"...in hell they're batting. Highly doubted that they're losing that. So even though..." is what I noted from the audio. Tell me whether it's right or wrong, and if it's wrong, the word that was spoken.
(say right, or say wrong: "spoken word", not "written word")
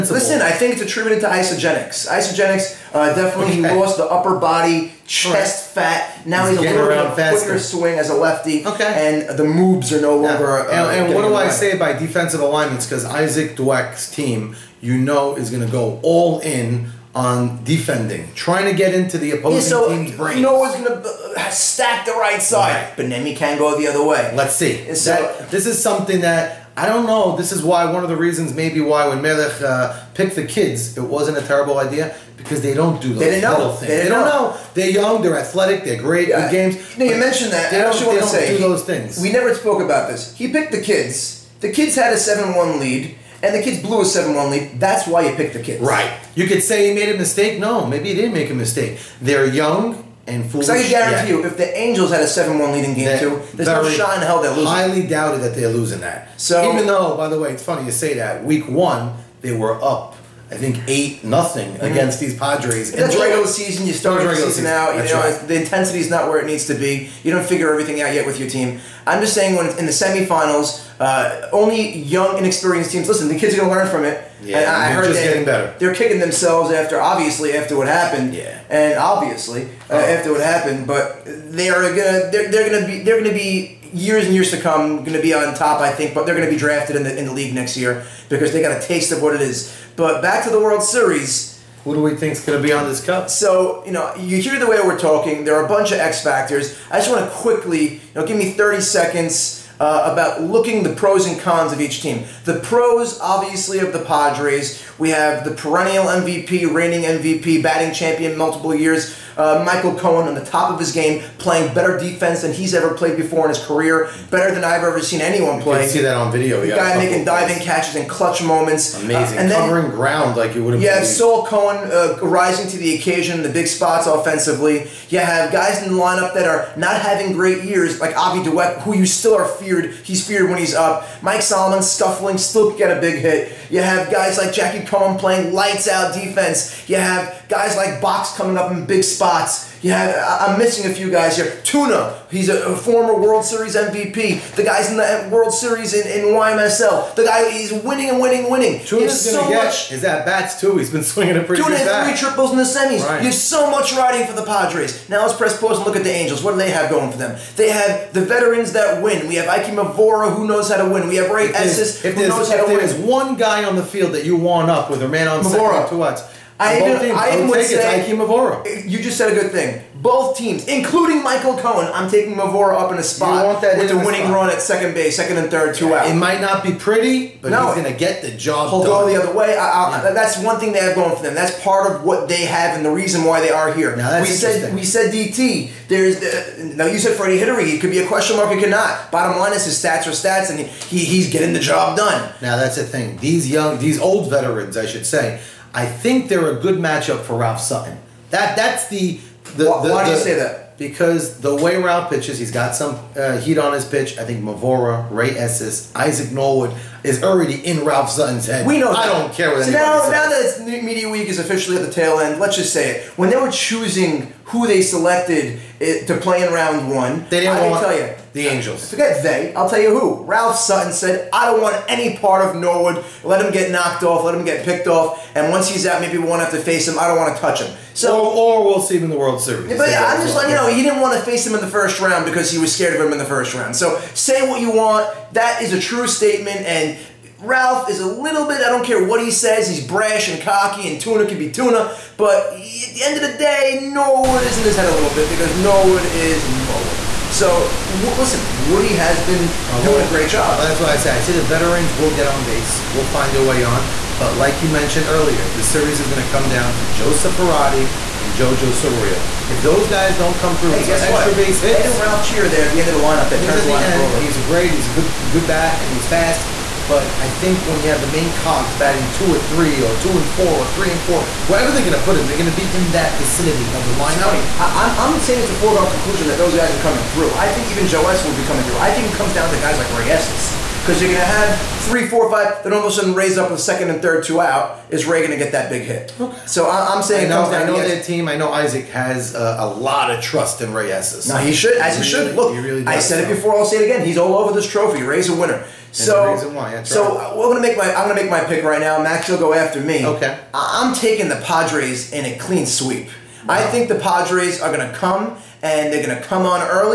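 wrong: "losing", not "batting".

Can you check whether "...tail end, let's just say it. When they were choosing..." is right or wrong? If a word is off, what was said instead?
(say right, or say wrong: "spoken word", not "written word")
right.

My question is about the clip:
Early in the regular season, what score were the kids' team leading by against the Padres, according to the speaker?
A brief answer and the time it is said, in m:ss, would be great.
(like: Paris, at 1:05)
8-0, at 1:00.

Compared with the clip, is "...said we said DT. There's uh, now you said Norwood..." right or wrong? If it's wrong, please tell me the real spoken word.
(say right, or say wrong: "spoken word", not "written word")
wrong: "Freddie", not "Norwood".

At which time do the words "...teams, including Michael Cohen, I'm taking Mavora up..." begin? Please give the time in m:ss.
2:50.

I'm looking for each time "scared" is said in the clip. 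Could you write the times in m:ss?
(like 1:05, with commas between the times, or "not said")
3:52.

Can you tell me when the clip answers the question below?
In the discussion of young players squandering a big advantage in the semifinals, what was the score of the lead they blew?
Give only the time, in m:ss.
0:42.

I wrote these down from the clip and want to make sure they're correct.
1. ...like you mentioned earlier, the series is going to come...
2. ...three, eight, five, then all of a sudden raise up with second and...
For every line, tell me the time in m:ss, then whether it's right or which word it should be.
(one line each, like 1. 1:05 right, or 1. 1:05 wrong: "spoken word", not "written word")
1. 4:14 right
2. 4:41 wrong: "four", not "eight".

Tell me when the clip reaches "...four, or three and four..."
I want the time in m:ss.
4:30.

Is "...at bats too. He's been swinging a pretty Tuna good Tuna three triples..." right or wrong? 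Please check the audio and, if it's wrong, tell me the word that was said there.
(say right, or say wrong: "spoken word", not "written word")
right.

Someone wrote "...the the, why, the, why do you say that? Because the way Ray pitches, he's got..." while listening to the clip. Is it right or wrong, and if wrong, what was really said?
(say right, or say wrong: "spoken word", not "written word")
wrong: "Rao", not "Ray".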